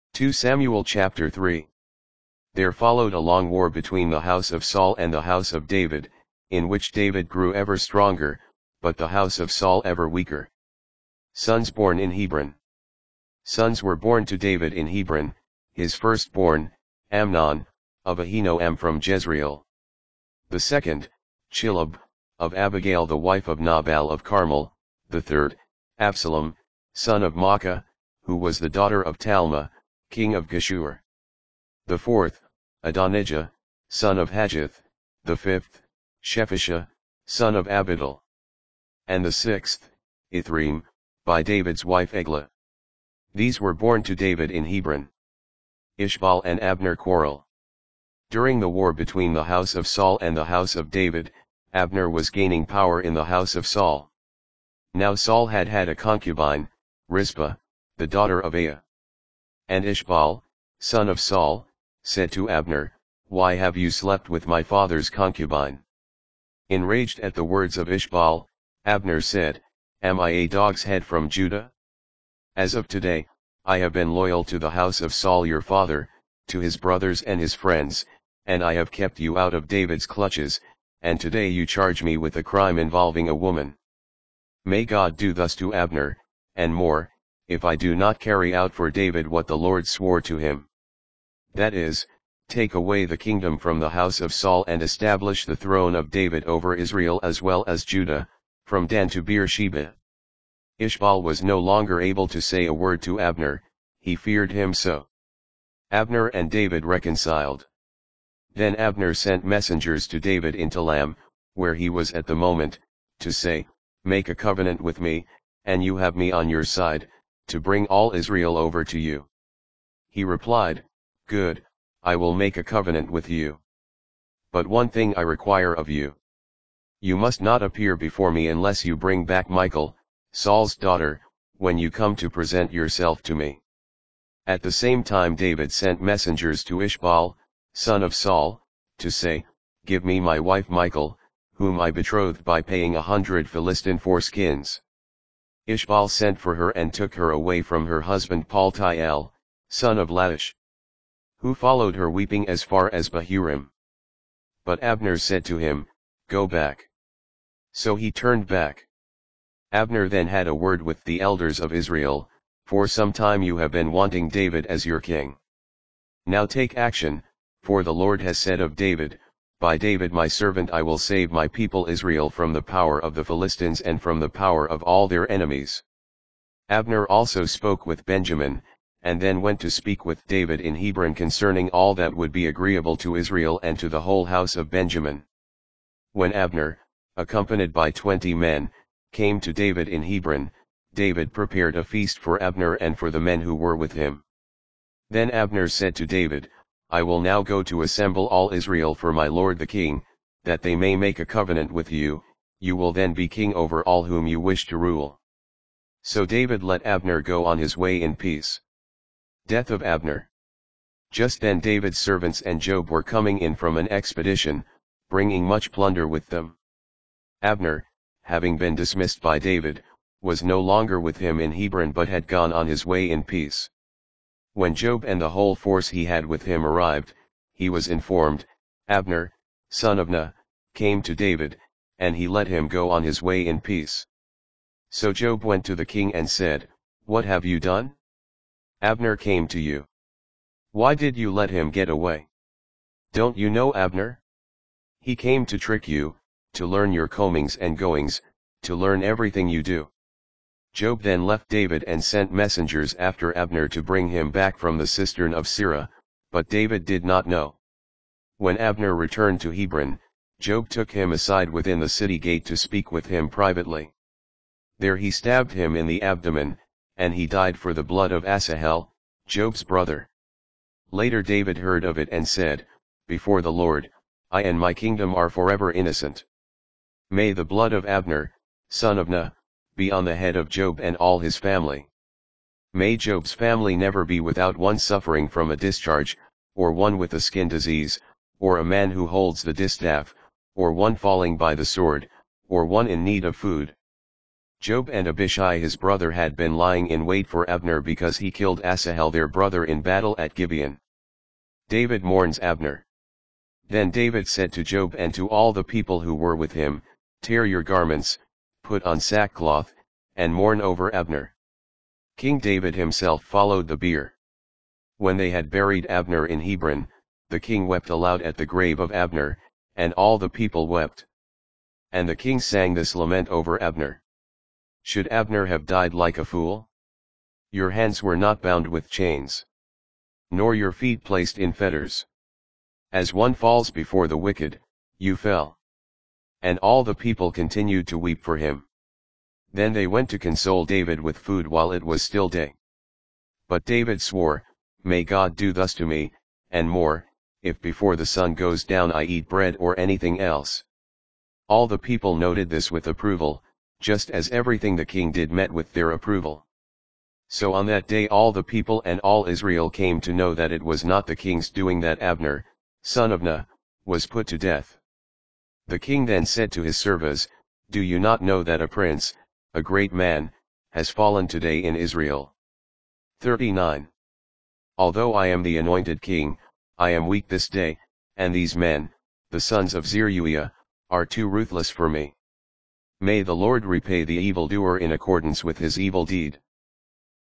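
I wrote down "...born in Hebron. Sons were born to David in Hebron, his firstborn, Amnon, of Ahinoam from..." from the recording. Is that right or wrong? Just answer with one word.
right.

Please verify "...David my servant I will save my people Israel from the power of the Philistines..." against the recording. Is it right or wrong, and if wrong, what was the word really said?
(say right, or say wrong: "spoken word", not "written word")
right.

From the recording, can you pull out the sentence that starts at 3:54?
So Joab went to the king and said, What have you done?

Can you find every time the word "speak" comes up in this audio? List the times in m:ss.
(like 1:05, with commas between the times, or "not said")
2:59, 4:22.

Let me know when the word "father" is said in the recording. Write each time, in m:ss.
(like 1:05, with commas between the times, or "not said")
1:04, 1:15.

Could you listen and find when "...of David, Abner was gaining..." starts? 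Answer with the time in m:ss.
0:50.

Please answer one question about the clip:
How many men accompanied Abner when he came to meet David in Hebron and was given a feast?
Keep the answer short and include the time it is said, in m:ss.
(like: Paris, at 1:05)
20, at 3:07.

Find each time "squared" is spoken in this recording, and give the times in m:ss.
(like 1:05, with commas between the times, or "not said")
not said.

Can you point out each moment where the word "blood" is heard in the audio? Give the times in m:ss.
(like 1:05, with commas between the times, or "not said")
4:27, 4:37.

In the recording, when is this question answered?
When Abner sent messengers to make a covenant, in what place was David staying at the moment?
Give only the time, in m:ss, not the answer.
1:50.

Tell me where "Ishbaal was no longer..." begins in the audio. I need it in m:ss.
1:40.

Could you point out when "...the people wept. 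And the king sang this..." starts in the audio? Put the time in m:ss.
5:20.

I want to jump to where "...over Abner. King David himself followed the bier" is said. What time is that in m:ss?
5:10.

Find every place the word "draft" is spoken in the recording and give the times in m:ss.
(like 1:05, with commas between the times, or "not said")
not said.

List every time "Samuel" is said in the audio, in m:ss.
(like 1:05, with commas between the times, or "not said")
0:00.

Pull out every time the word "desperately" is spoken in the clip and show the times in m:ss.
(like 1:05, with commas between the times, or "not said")
not said.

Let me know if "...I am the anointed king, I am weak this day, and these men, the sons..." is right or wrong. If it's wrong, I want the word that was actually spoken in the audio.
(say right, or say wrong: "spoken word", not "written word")
right.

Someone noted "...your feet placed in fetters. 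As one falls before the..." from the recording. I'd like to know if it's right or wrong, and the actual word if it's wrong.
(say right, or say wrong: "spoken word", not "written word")
right.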